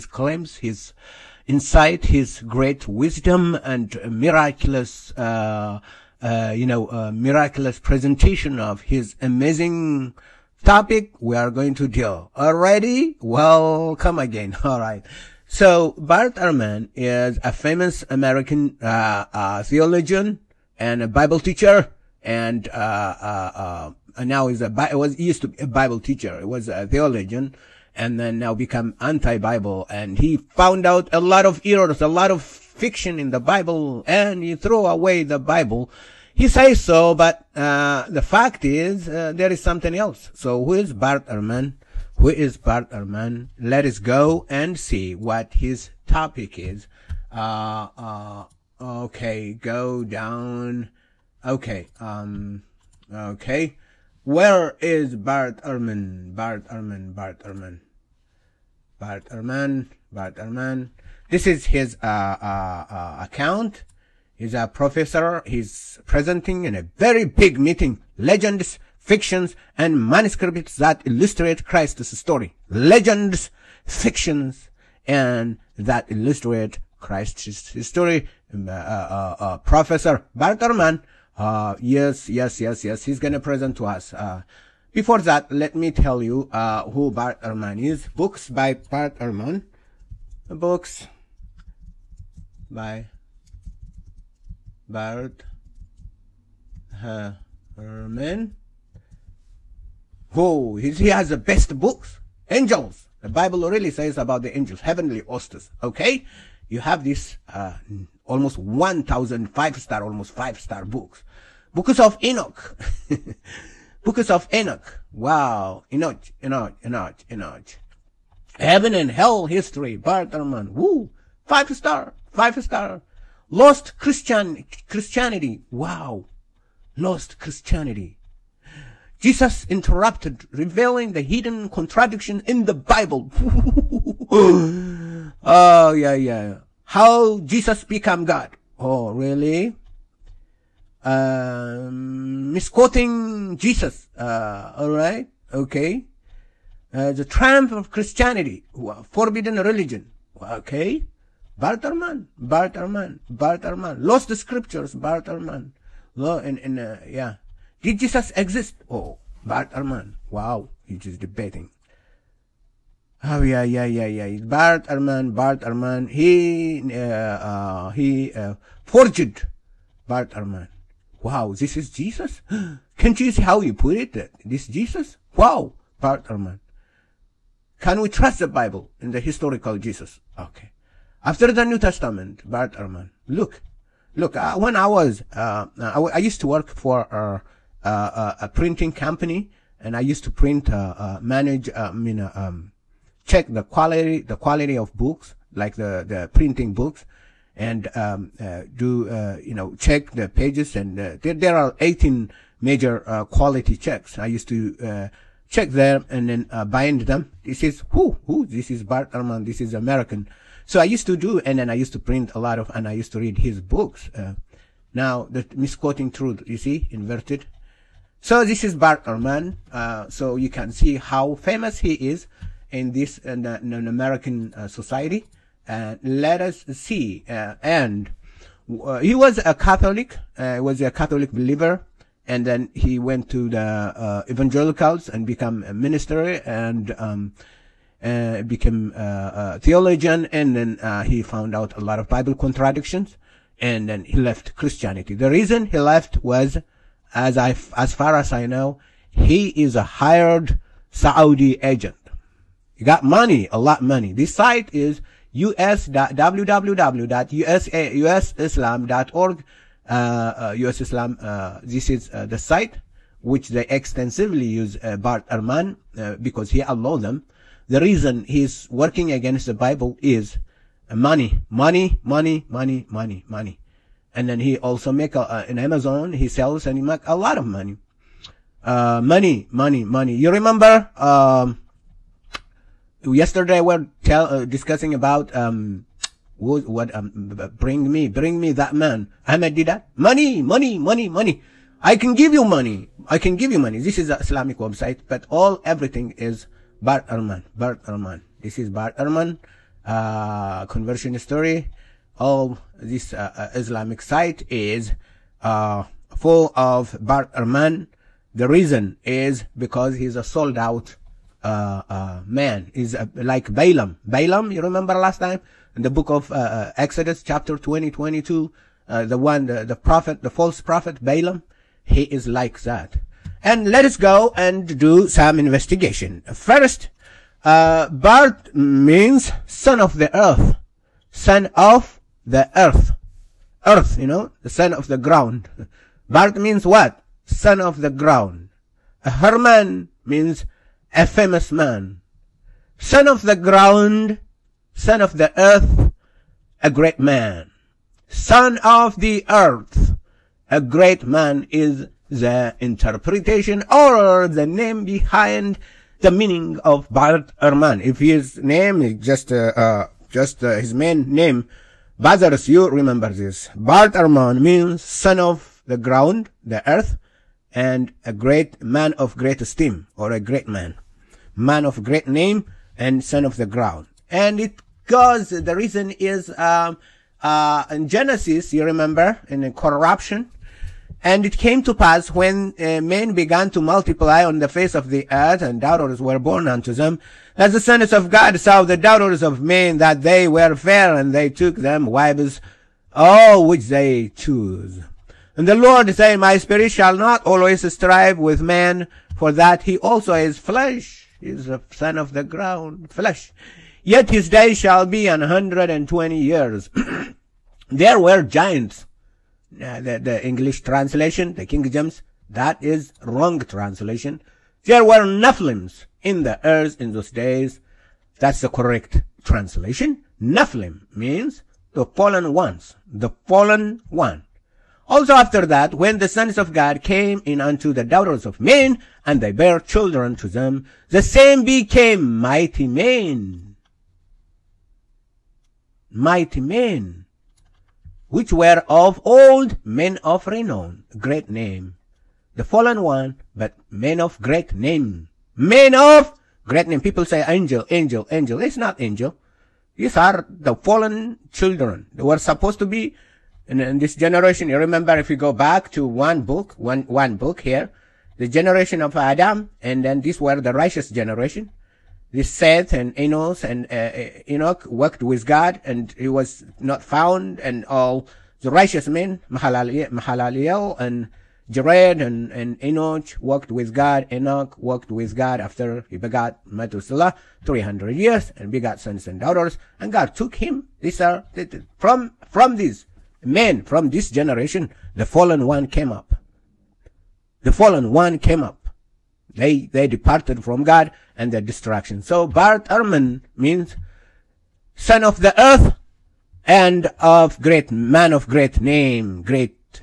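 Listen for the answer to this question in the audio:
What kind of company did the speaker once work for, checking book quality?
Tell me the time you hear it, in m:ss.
3:08.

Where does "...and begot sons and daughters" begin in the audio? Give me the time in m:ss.
7:58.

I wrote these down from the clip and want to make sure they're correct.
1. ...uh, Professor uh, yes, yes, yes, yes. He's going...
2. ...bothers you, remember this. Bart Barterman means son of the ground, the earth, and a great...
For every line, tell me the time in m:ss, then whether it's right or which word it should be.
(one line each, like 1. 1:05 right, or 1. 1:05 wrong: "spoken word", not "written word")
1. 1:19 right
2. 6:01 wrong: "Arman", not "Barterman".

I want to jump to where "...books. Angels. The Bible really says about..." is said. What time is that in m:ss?
1:41.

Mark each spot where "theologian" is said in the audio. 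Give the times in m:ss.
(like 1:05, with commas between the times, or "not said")
0:19, 0:26, 3:59.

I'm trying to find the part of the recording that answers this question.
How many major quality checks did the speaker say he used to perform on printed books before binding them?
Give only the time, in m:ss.
3:21.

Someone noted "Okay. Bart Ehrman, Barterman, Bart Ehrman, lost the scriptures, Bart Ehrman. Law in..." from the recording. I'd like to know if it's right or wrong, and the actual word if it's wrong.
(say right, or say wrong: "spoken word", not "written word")
right.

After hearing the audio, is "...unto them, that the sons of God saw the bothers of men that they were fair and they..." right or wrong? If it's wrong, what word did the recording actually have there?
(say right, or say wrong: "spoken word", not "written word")
wrong: "daughters", not "bothers".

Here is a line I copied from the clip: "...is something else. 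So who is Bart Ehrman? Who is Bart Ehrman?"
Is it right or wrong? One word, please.
right.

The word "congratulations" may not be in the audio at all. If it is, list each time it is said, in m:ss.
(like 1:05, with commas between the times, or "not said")
not said.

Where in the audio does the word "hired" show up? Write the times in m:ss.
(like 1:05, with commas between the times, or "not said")
4:09.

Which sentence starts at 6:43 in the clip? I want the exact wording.
Yet his days shall be an hundred and twenty years.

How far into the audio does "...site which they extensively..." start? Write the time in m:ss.
4:22.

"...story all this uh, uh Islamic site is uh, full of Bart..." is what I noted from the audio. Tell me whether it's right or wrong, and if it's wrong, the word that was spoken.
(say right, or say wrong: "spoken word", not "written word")
right.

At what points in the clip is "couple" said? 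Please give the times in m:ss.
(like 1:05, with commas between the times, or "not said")
not said.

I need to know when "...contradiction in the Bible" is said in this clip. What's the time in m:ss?
2:11.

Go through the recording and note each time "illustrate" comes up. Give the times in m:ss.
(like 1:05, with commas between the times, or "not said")
1:11, 1:16.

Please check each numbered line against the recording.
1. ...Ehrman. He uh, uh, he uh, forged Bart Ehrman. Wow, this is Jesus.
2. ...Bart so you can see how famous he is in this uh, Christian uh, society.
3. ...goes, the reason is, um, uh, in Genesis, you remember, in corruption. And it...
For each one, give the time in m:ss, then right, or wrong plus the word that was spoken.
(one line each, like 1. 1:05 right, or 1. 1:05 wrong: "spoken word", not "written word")
1. 2:45 right
2. 3:38 wrong: "American", not "Christian"
3. 6:14 right.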